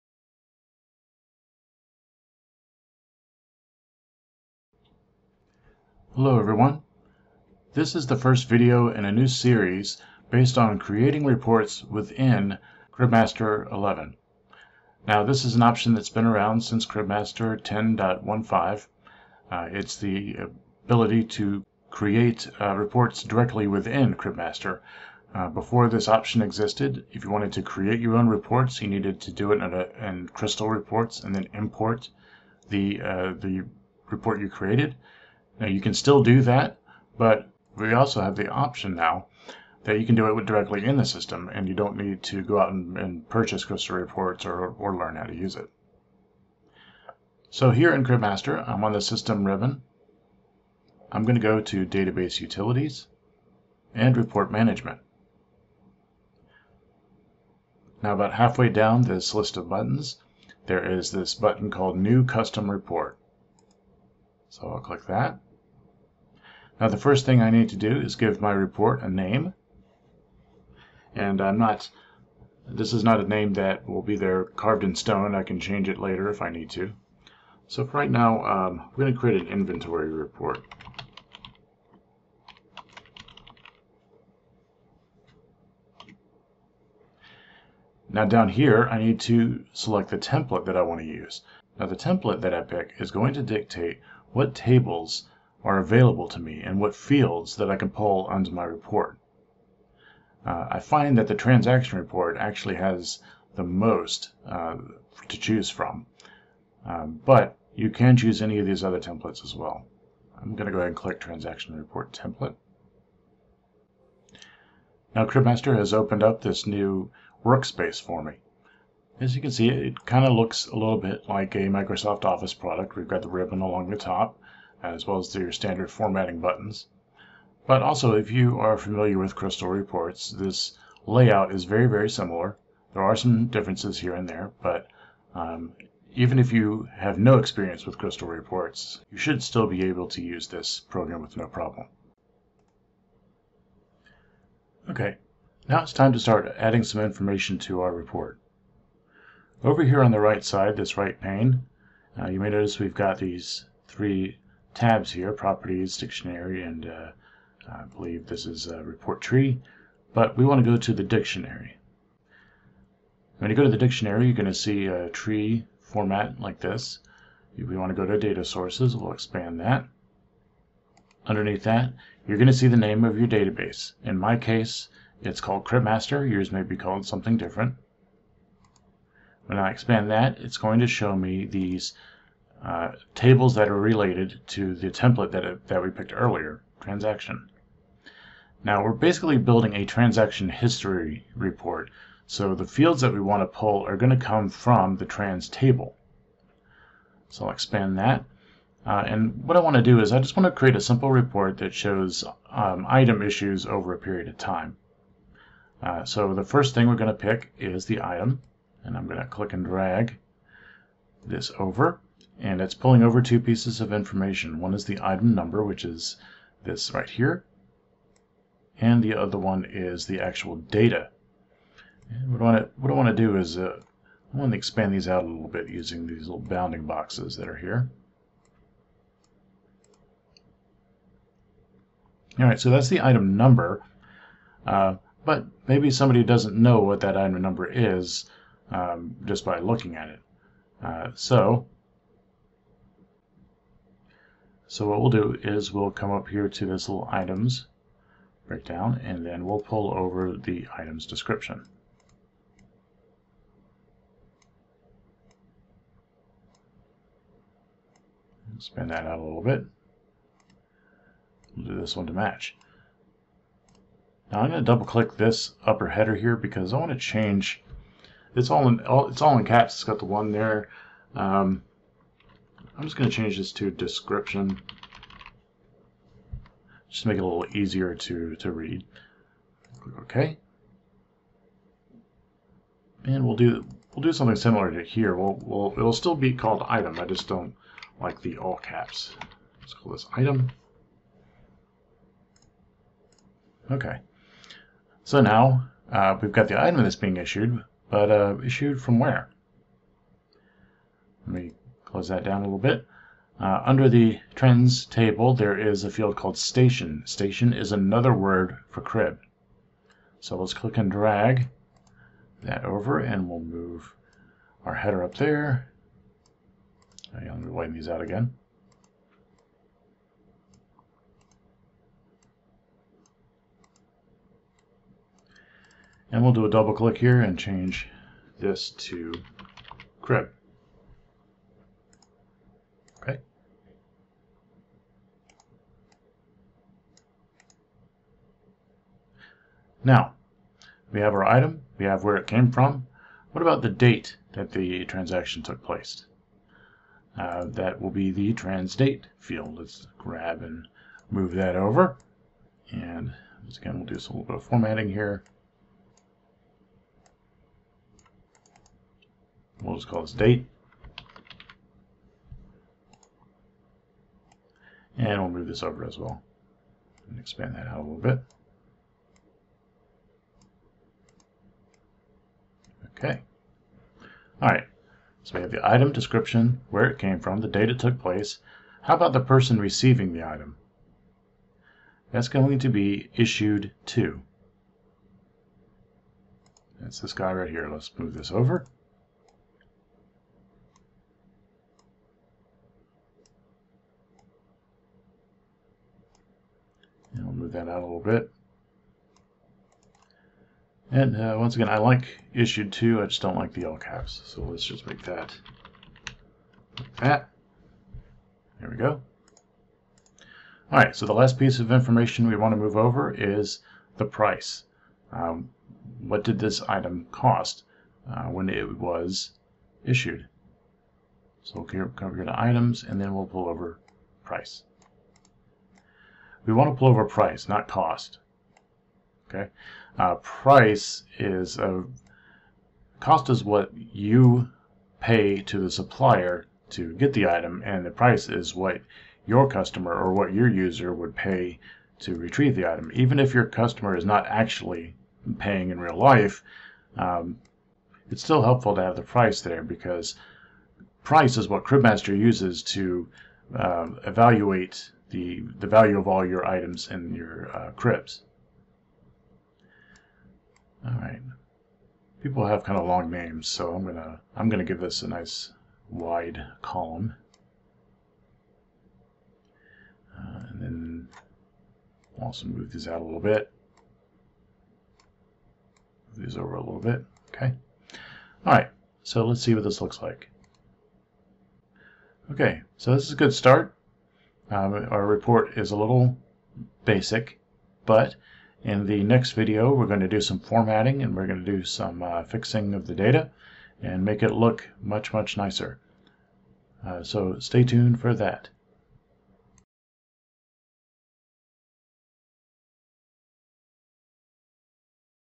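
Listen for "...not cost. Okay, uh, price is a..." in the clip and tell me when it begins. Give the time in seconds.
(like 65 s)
427 s.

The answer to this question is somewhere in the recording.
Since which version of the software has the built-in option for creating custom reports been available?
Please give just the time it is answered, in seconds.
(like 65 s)
16 s.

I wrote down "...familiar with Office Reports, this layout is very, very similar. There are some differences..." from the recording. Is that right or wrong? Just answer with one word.
wrong.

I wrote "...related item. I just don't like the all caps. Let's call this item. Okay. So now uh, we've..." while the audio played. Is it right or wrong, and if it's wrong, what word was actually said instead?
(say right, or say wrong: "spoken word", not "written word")
wrong: "called", not "related".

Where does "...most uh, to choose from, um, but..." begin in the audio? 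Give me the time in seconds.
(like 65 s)
103 s.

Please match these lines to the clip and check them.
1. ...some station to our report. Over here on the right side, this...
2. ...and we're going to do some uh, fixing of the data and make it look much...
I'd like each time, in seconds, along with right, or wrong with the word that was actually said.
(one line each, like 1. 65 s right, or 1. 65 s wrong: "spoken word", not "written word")
1. 146 s wrong: "information", not "station"
2. 491 s right.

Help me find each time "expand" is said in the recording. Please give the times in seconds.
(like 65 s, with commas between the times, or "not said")
169 s, 179 s, 197 s, 224 s, 367 s.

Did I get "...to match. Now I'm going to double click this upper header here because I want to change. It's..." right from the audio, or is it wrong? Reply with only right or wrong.
right.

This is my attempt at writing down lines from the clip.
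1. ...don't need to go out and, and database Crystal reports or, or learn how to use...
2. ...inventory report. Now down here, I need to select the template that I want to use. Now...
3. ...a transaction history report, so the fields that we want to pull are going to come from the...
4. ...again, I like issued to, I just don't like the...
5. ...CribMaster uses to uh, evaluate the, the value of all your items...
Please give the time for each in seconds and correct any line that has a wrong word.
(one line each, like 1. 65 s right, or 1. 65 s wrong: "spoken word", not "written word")
1. 41 s wrong: "purchase", not "database"
2. 79 s right
3. 189 s right
4. 401 s right
5. 451 s right.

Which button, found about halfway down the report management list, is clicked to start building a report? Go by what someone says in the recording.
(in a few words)
new custom report.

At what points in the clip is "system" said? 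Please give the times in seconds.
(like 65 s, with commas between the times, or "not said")
41 s, 49 s.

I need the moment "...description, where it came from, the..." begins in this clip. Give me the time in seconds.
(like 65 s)
375 s.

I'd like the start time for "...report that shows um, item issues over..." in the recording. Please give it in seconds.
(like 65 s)
201 s.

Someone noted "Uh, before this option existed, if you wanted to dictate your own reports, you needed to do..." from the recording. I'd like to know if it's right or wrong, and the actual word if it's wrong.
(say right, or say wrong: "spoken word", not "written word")
wrong: "create", not "dictate".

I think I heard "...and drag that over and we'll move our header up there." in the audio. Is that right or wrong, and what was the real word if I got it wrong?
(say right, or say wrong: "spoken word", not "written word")
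right.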